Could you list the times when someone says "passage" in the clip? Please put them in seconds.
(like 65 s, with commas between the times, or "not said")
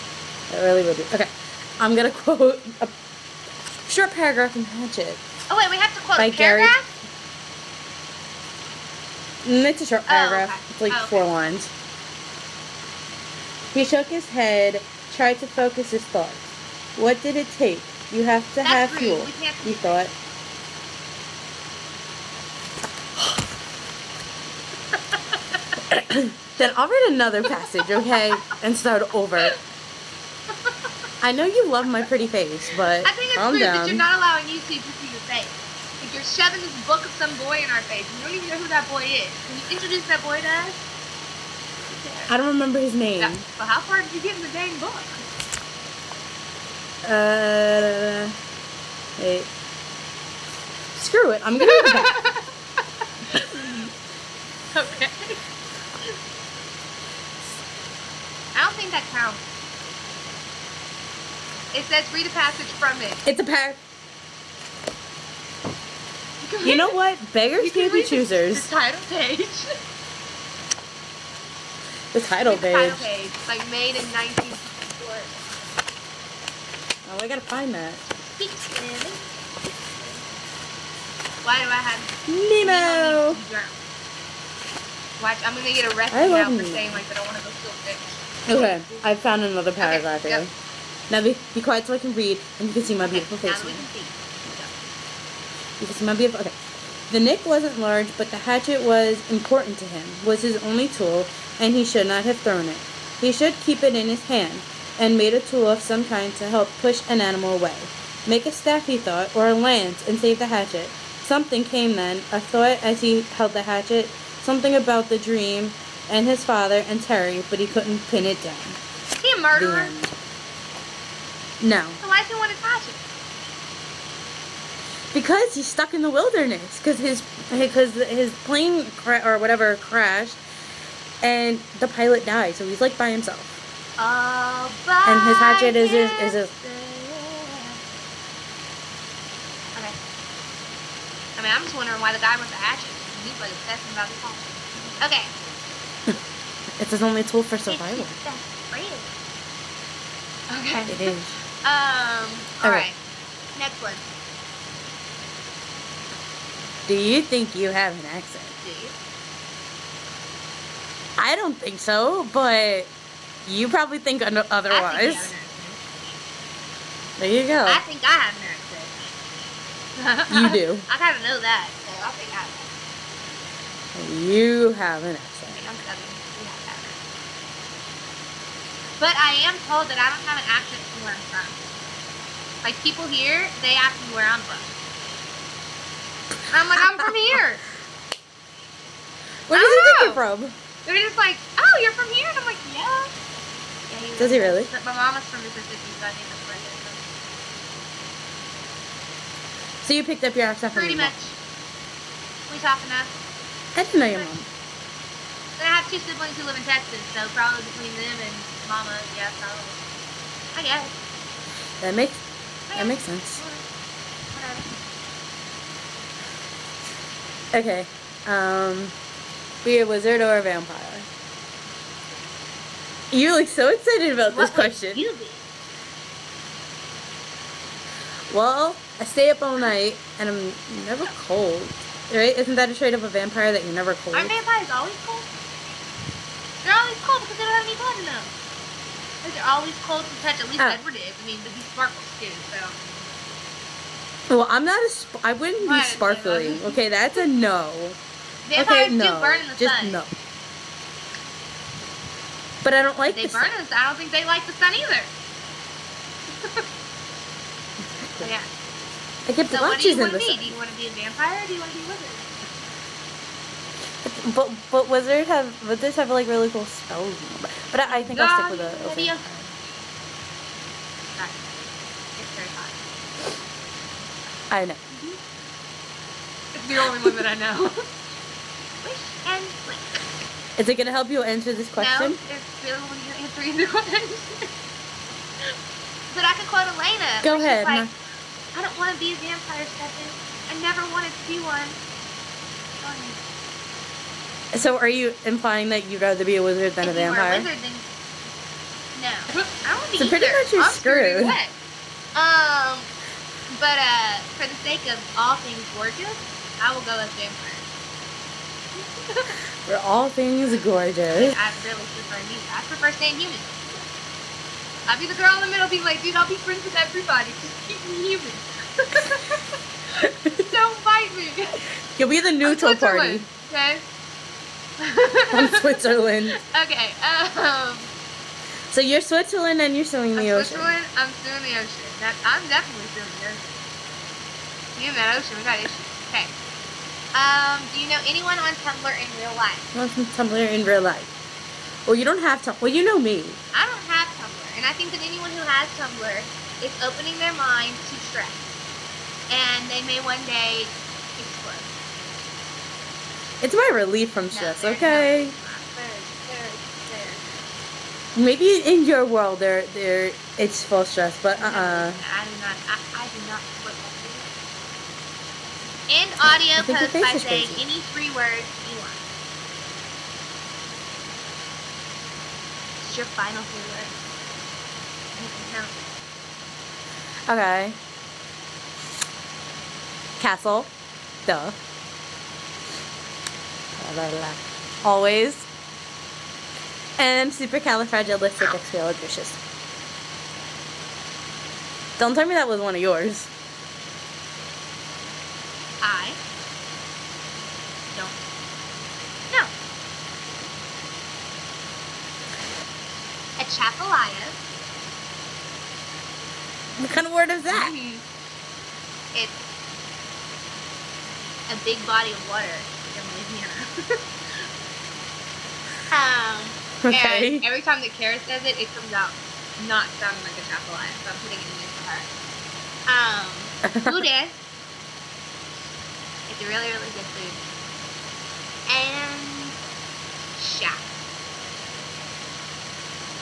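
27 s, 62 s.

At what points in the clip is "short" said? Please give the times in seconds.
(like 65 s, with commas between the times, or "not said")
3 s, 9 s.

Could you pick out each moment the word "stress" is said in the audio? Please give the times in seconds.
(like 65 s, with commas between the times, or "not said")
348 s, 354 s, 360 s.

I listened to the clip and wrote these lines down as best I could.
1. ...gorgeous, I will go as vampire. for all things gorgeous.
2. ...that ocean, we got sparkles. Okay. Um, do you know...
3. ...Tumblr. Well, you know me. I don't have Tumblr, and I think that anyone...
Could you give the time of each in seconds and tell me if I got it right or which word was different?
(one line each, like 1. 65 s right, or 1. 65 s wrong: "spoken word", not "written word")
1. 305 s right
2. 334 s wrong: "issues", not "sparkles"
3. 342 s right.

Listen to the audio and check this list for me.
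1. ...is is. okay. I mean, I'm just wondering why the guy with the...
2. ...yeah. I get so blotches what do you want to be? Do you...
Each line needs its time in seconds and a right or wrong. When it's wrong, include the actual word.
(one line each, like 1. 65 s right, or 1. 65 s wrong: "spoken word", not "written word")
1. 135 s right
2. 258 s right.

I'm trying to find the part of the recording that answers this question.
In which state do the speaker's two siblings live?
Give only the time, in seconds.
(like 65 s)
206 s.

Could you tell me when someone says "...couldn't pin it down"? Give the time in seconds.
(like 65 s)
117 s.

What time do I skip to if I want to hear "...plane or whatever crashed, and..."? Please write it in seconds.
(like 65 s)
128 s.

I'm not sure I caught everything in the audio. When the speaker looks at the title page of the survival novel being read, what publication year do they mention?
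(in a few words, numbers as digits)
1964.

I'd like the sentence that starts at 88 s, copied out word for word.
Okay, I found another paragraph okay, here.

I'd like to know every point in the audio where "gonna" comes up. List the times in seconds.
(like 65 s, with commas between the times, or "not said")
1 s, 51 s, 85 s, 280 s.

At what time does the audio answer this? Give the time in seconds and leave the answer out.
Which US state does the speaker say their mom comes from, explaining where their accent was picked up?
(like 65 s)
195 s.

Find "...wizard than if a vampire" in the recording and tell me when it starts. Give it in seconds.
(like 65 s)
296 s.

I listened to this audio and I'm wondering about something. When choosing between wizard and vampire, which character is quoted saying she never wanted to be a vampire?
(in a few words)
Elena.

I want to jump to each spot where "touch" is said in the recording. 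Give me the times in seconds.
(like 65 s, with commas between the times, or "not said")
122 s, 240 s.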